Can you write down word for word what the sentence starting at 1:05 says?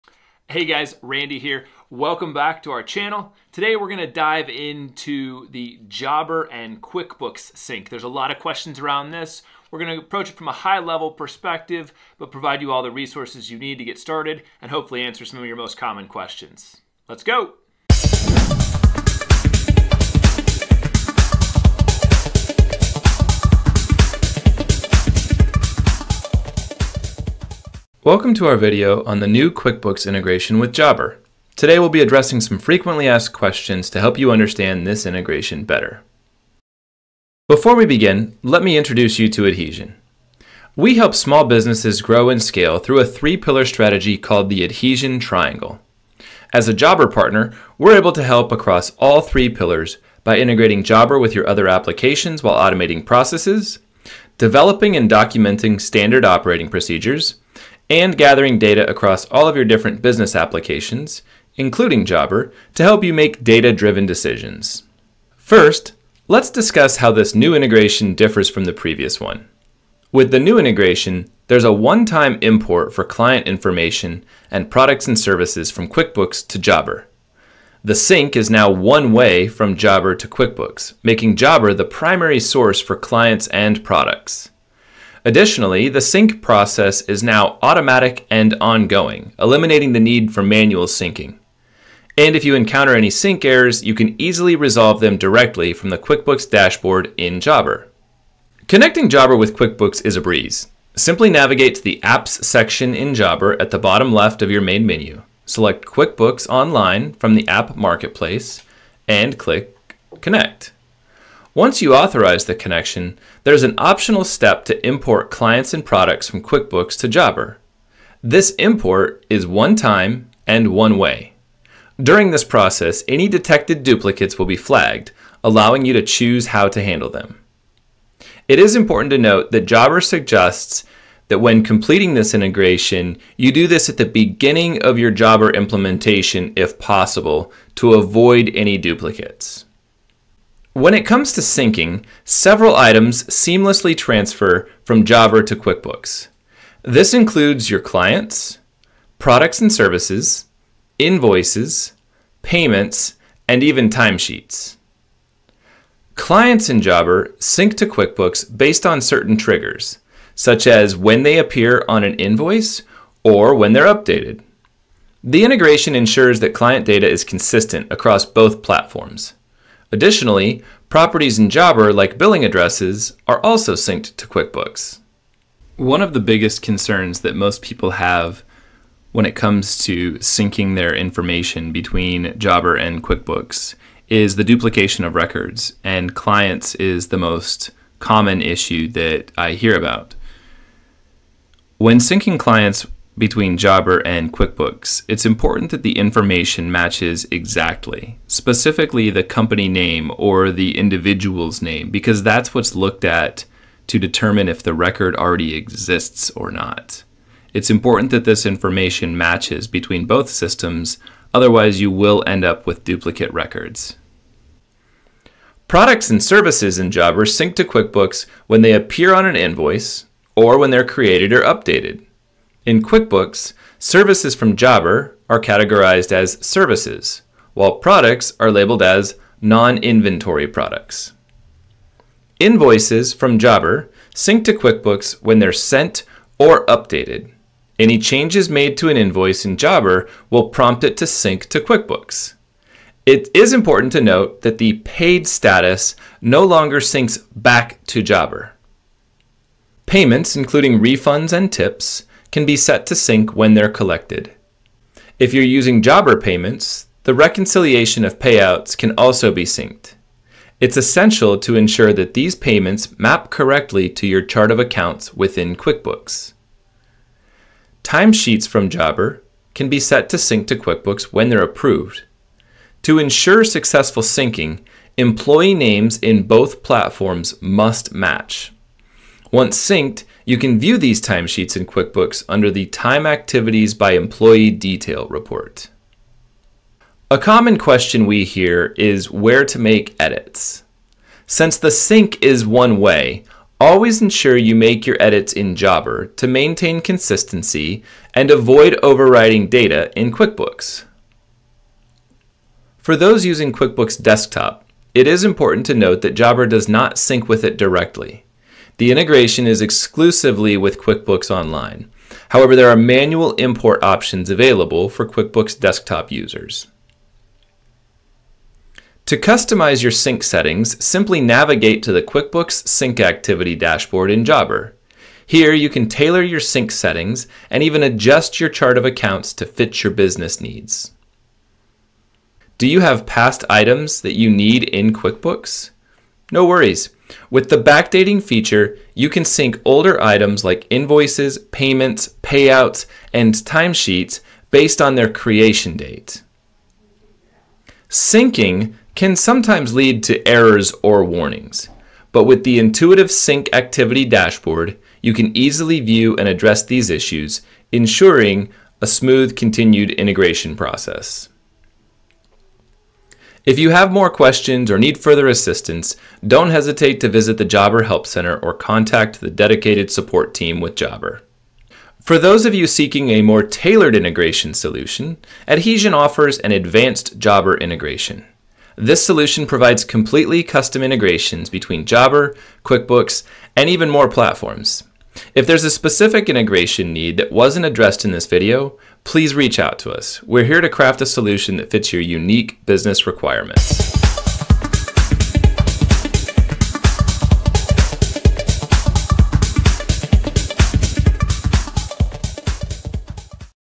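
First, let's discuss how this new integration differs from the previous one.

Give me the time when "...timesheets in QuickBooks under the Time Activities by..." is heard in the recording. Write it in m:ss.
4:41.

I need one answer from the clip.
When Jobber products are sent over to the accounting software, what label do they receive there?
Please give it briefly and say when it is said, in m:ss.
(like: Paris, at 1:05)
Non-inventory products, at 3:49.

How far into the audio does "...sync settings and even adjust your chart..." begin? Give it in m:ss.
5:26.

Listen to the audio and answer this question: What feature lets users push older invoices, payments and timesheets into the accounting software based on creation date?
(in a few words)
Backdating feature.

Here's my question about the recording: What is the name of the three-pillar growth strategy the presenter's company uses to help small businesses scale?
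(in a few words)
Adhesion Triangle.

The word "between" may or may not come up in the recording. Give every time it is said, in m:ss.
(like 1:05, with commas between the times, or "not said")
3:01, 3:13, 3:29, 6:21.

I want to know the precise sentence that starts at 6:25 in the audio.
If there's a specific integration need that wasn't addressed in this video, please reach out to us.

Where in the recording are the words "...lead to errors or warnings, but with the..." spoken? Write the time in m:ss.
5:49.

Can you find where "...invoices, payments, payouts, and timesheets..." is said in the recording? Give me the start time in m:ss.
5:40.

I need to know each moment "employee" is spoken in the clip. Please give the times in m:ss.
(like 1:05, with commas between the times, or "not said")
4:34, 4:43.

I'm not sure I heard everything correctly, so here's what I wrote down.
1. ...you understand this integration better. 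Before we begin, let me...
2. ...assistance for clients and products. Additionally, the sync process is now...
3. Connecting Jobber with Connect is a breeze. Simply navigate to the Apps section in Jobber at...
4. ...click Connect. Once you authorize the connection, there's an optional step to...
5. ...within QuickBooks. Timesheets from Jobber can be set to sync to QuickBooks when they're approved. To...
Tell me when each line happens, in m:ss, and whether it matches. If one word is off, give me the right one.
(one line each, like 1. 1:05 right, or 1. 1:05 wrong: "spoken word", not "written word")
1. 0:34 right
2. 1:22 wrong: "source", not "assistance"
3. 1:38 wrong: "QuickBooks", not "Connect"
4. 1:49 right
5. 4:25 right.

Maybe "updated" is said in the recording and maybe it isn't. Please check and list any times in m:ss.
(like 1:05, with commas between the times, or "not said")
2:43, 3:41, 3:56.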